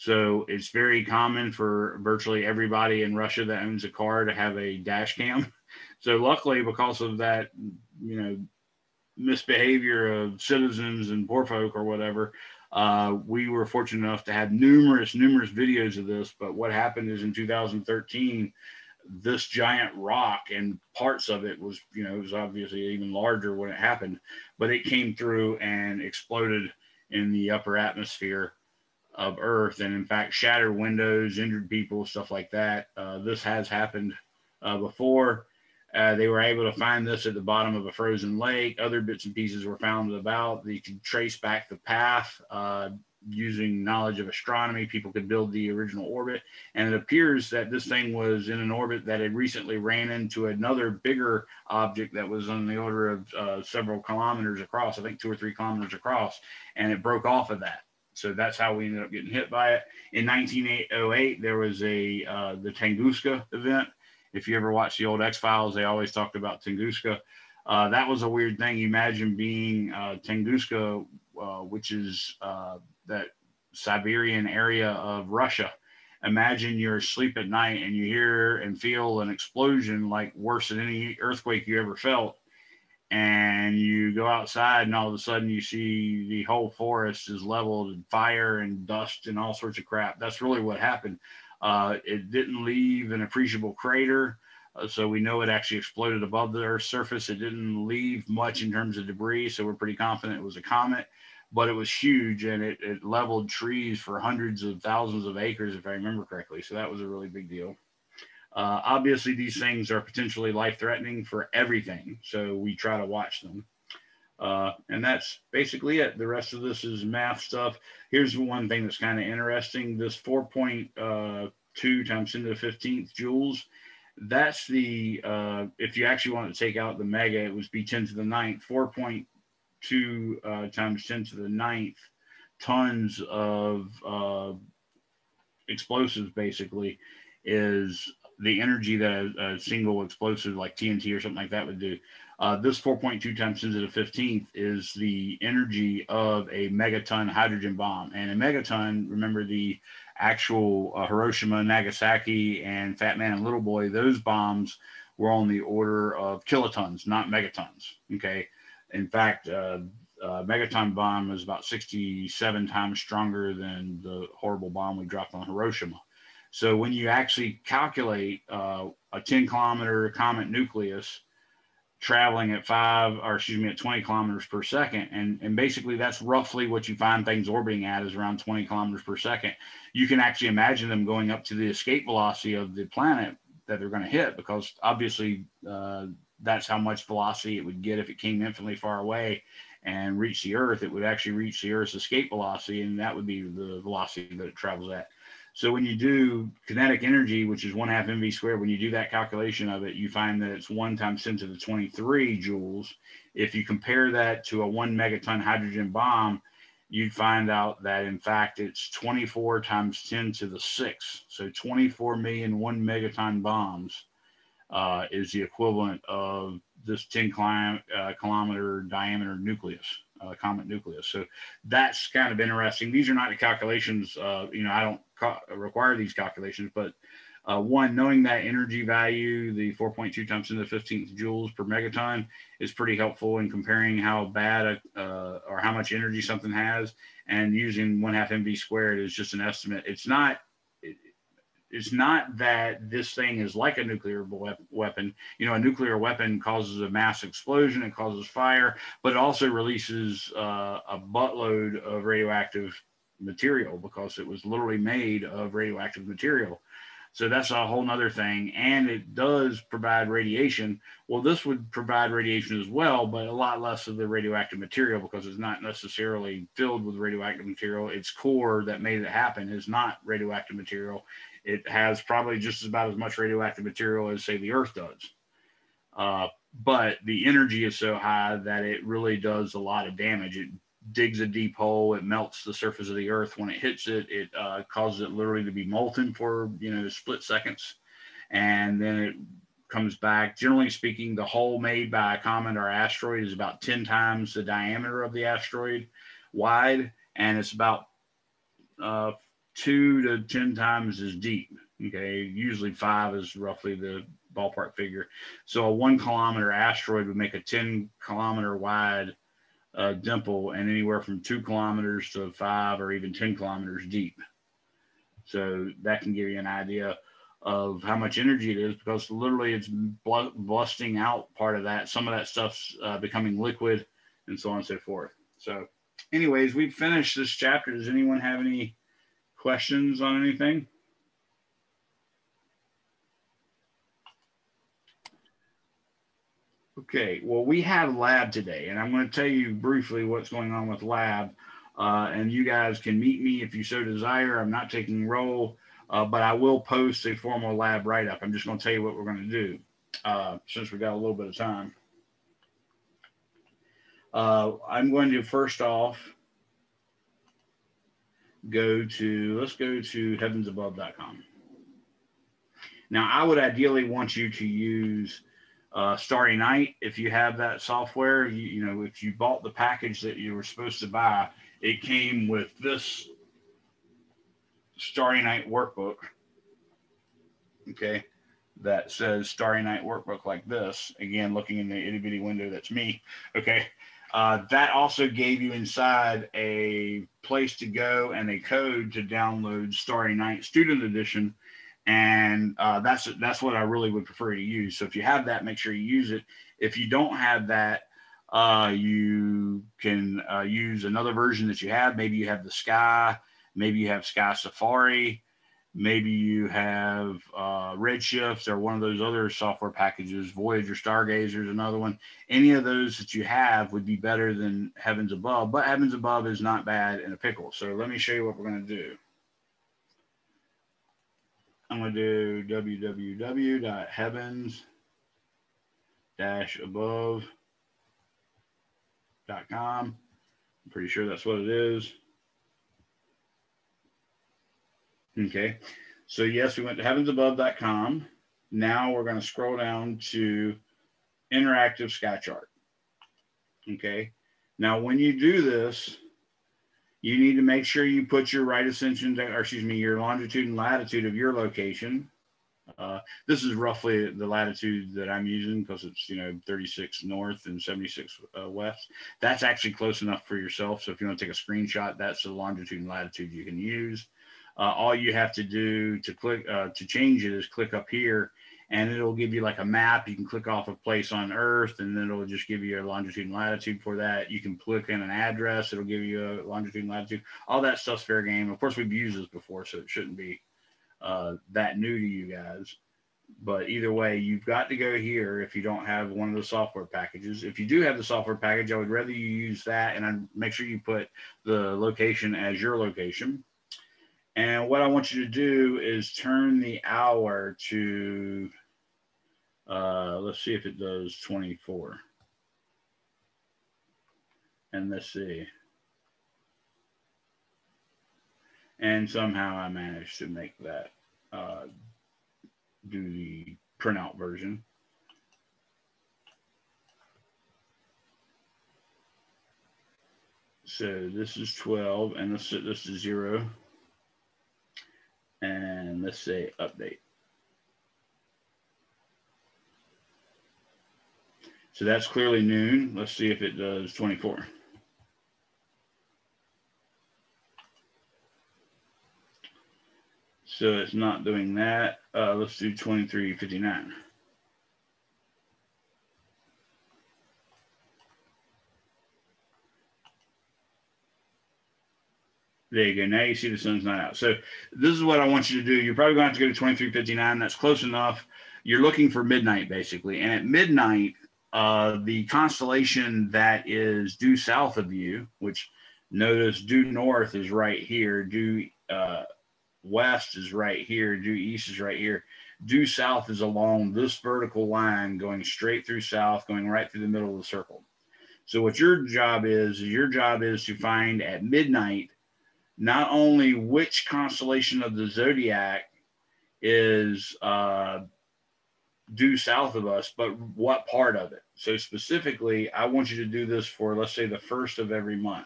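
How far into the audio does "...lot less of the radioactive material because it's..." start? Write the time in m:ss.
4:23.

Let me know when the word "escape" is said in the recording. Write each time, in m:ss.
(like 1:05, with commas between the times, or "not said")
3:01, 3:11.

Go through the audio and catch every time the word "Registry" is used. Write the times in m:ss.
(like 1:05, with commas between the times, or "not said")
not said.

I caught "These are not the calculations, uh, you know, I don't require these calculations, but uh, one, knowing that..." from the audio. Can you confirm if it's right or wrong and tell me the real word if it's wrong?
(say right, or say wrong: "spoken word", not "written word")
right.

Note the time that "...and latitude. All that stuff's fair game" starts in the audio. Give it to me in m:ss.
7:56.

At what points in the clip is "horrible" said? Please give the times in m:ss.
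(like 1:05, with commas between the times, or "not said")
2:44.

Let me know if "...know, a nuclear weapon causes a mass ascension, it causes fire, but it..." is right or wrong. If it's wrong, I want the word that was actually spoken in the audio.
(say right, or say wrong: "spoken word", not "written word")
wrong: "explosion", not "ascension".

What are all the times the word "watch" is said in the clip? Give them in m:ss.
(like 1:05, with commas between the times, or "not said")
1:04, 1:53.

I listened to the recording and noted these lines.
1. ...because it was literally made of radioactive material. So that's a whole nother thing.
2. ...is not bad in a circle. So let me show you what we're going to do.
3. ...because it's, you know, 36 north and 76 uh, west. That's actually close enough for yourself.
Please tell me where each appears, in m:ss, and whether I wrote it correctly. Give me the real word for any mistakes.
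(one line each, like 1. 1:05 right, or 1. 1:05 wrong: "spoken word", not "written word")
1. 4:13 right
2. 6:56 wrong: "pickle", not "circle"
3. 7:35 right.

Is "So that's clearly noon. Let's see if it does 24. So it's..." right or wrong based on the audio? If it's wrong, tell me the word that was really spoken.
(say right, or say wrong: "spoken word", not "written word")
right.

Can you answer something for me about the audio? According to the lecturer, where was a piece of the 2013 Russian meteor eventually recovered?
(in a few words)
bottom of a frozen lake.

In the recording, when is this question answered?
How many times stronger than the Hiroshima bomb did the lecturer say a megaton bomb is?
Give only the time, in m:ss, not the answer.
2:41.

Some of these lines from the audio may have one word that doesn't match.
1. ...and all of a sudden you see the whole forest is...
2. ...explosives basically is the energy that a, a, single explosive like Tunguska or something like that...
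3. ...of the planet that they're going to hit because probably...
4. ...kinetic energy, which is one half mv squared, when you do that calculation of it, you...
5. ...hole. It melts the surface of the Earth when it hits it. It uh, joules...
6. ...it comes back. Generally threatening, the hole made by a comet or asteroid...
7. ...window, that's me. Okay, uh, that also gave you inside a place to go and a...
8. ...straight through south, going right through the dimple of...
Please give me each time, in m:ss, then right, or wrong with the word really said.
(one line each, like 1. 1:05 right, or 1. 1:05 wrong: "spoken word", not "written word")
1. 1:24 right
2. 2:15 wrong: "TNT", not "Tunguska"
3. 3:02 wrong: "obviously", not "probably"
4. 3:16 right
5. 4:41 wrong: "causes", not "joules"
6. 4:48 wrong: "speaking", not "threatening"
7. 6:22 right
8. 9:35 wrong: "middle", not "dimple".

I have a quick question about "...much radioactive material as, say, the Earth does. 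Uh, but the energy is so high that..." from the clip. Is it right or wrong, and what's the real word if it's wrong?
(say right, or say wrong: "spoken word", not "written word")
right.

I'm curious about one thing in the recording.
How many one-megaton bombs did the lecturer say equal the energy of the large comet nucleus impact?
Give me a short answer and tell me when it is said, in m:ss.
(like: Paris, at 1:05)
24 million, at 3:31.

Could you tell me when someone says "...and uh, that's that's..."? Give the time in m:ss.
6:31.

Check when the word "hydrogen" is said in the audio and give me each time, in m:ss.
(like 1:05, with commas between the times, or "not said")
2:27, 3:25.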